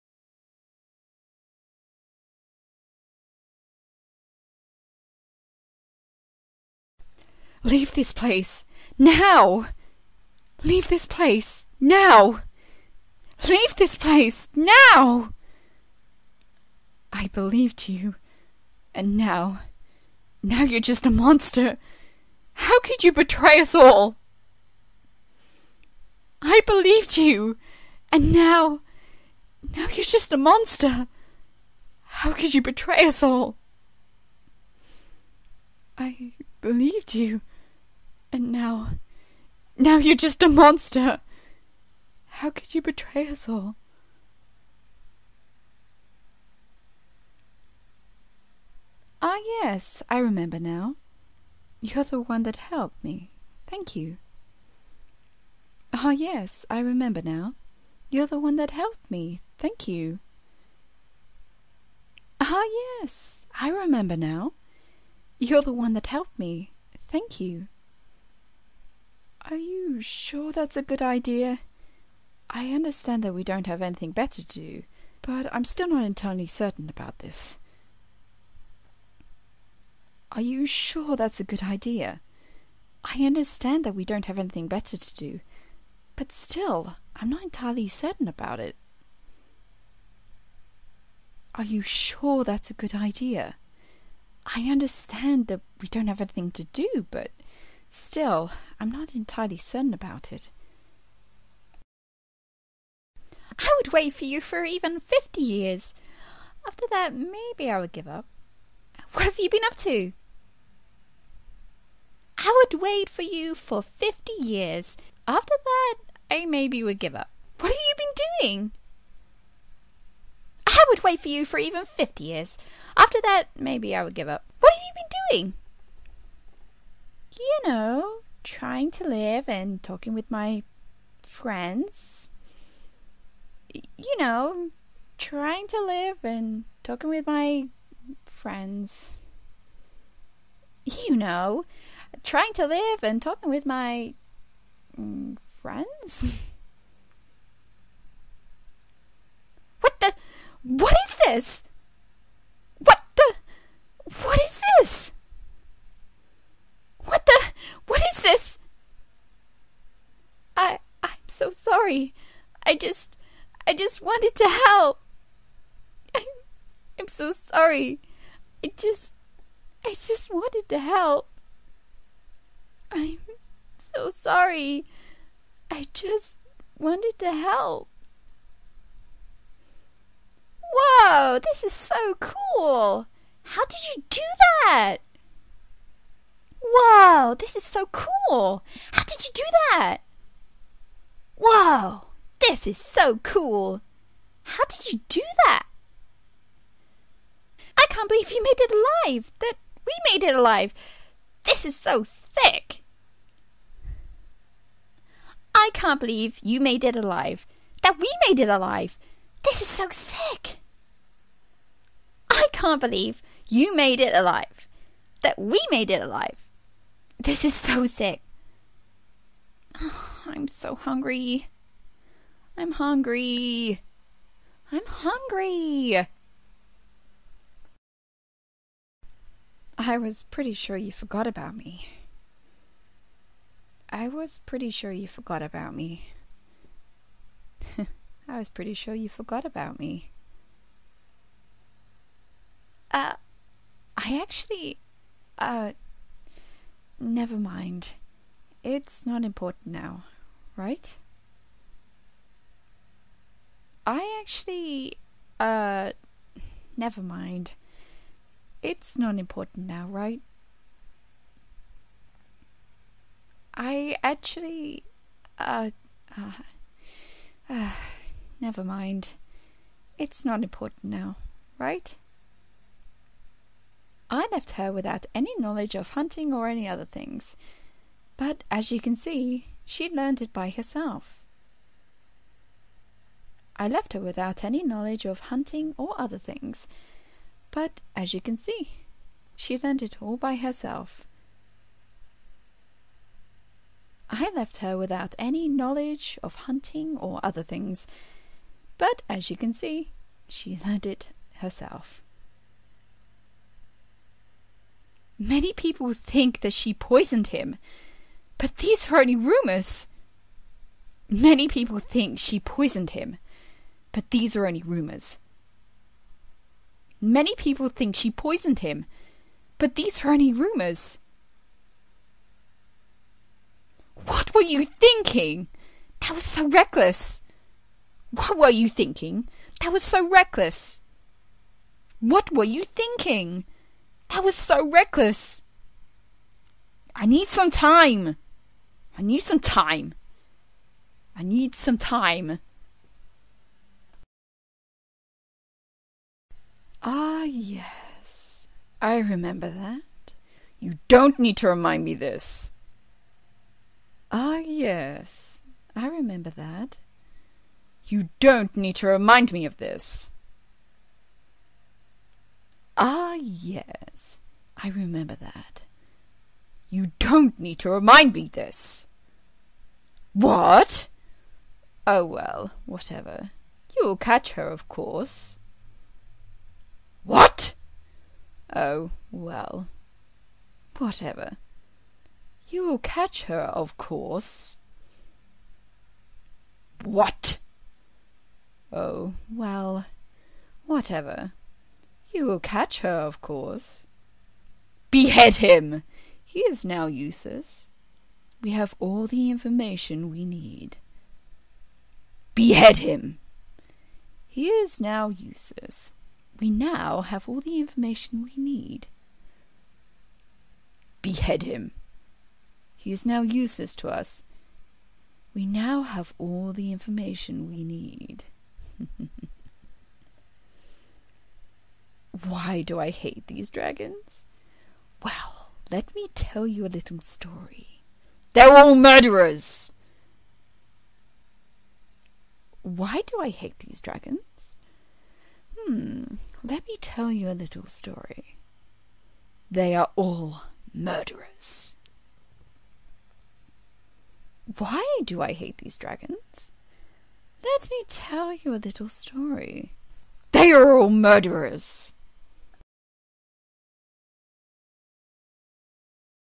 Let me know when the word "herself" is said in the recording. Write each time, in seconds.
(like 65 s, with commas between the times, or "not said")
280 s, 290 s, 301 s.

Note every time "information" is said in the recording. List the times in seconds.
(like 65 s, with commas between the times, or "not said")
399 s, 407 s, 416 s.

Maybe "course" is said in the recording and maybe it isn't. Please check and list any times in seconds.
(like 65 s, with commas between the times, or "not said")
374 s, 383 s, 393 s.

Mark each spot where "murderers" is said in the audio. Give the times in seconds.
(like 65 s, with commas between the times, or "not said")
428 s, 440 s, 450 s.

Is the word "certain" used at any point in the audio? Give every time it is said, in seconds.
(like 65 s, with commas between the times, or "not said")
76 s, 87 s, 99 s.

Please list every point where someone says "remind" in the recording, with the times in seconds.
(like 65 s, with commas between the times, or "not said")
351 s, 358 s, 367 s.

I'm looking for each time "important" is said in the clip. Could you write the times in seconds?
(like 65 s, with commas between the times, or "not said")
249 s, 259 s, 270 s.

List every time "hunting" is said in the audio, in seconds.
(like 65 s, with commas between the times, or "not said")
275 s, 285 s, 296 s.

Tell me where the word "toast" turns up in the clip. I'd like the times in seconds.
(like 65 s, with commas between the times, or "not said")
not said.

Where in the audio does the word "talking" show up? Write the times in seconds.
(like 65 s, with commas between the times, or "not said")
129 s, 136 s, 143 s.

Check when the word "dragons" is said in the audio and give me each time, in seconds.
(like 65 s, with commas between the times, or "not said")
423 s, 433 s, 445 s.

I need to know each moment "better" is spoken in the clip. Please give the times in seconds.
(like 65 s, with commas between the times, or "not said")
74 s, 84 s.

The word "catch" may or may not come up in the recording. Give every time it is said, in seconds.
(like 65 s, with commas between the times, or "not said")
373 s, 382 s, 392 s.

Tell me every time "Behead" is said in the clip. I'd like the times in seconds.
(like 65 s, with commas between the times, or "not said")
394 s, 402 s, 411 s.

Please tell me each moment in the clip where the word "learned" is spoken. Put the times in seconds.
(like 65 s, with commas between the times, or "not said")
279 s, 289 s, 300 s.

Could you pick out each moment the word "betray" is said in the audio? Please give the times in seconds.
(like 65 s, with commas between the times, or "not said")
23 s, 32 s, 42 s.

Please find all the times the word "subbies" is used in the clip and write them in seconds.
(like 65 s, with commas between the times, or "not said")
not said.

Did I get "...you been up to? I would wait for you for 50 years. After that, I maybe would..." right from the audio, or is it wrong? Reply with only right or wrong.
right.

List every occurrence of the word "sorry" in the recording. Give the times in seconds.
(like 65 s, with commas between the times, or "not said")
161 s, 167 s, 174 s.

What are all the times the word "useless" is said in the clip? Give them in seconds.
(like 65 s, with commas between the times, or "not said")
396 s, 405 s, 413 s.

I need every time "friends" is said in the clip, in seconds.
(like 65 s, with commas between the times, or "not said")
131 s, 138 s, 145 s.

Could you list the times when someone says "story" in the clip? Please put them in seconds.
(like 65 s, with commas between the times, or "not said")
426 s, 437 s, 448 s.